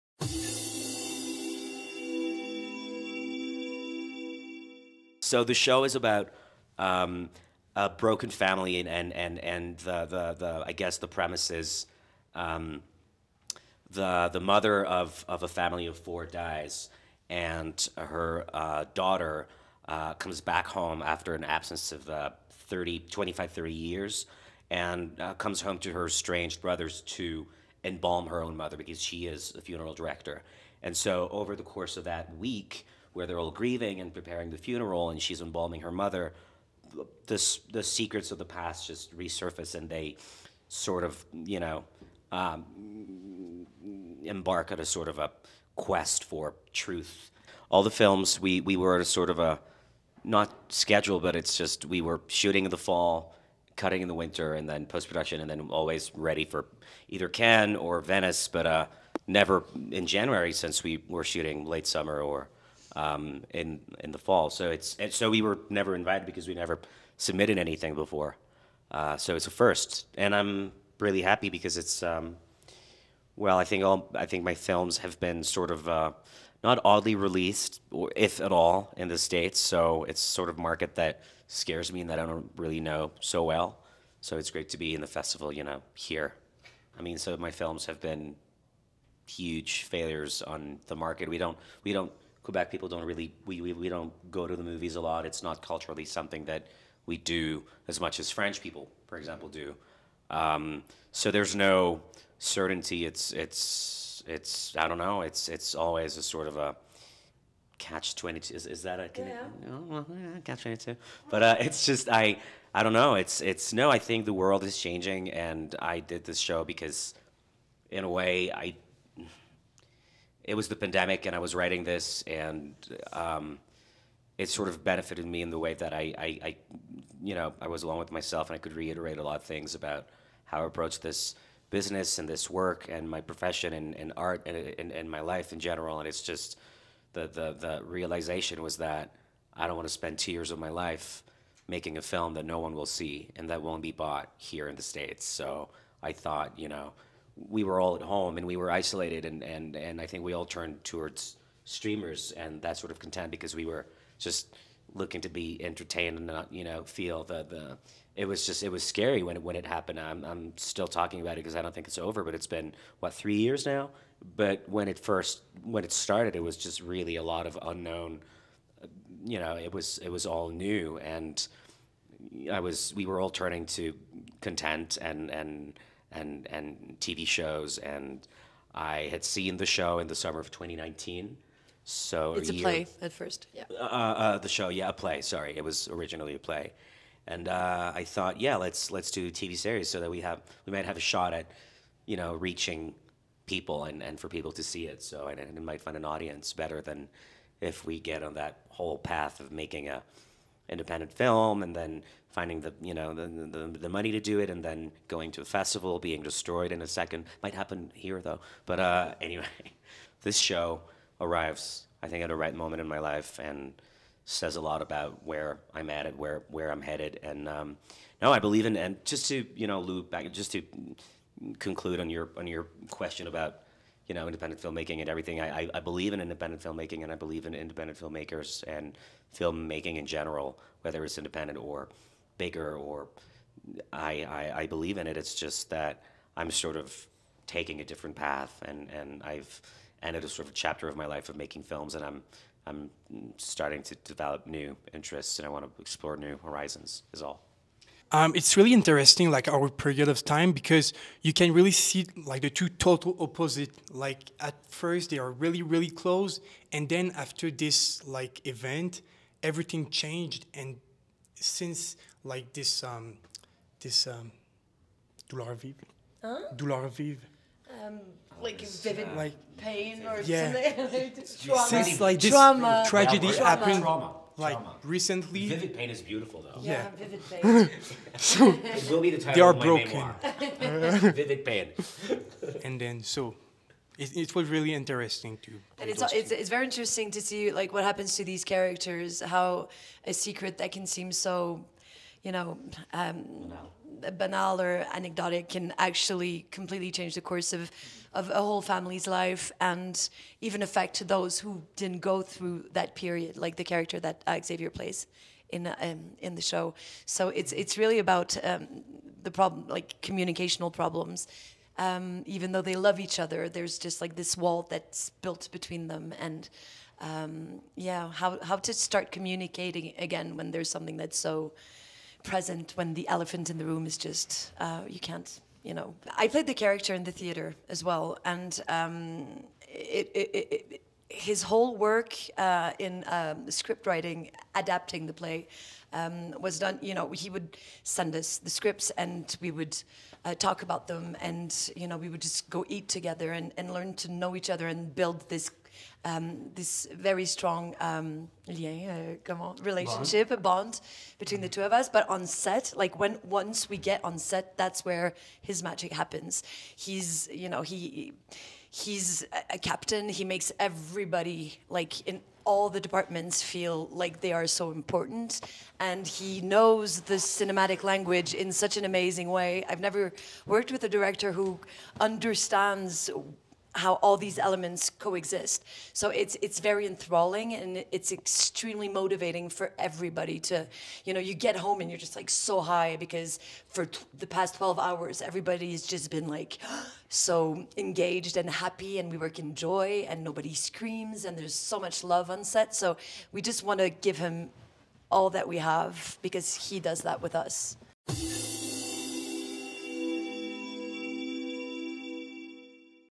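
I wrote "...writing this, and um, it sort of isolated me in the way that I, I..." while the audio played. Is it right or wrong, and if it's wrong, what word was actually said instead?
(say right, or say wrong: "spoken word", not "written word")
wrong: "benefited", not "isolated".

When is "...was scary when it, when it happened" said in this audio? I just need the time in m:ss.
2:38.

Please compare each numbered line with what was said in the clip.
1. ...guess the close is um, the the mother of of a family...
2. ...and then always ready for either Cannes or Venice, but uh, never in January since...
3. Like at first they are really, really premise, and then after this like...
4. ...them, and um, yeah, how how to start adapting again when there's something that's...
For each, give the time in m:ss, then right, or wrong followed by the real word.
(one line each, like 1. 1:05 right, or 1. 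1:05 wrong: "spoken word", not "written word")
1. 0:10 wrong: "premise", not "close"
2. 0:55 right
3. 4:13 wrong: "close", not "premise"
4. 5:15 wrong: "communicating", not "adapting".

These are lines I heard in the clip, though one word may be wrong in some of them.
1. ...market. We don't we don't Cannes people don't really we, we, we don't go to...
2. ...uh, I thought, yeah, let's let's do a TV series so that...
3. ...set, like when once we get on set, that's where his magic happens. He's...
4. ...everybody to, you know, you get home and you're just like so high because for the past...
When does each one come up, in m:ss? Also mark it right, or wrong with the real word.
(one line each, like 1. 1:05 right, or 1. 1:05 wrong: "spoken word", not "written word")
1. 1:30 wrong: "Quebec", not "Cannes"
2. 3:07 right
3. 5:52 right
4. 6:19 right.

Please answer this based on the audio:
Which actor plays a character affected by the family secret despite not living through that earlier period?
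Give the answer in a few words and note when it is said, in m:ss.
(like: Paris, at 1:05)
Xavier, at 5:04.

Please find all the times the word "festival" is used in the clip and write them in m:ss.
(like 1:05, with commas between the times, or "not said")
1:25, 3:25.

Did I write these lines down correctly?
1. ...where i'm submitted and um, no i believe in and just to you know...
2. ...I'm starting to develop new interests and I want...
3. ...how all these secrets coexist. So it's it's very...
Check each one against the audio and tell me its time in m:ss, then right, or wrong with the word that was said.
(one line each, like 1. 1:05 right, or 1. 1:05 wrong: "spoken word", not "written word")
1. 3:36 wrong: "headed", not "submitted"
2. 4:02 right
3. 6:13 wrong: "elements", not "secrets".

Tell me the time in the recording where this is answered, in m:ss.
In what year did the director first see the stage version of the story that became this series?
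3:00.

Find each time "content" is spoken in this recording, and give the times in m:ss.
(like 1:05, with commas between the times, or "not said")
2:32, 2:54.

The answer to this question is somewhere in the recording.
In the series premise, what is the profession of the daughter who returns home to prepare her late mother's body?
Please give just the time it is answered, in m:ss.
0:29.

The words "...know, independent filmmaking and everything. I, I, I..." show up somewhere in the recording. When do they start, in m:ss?
3:44.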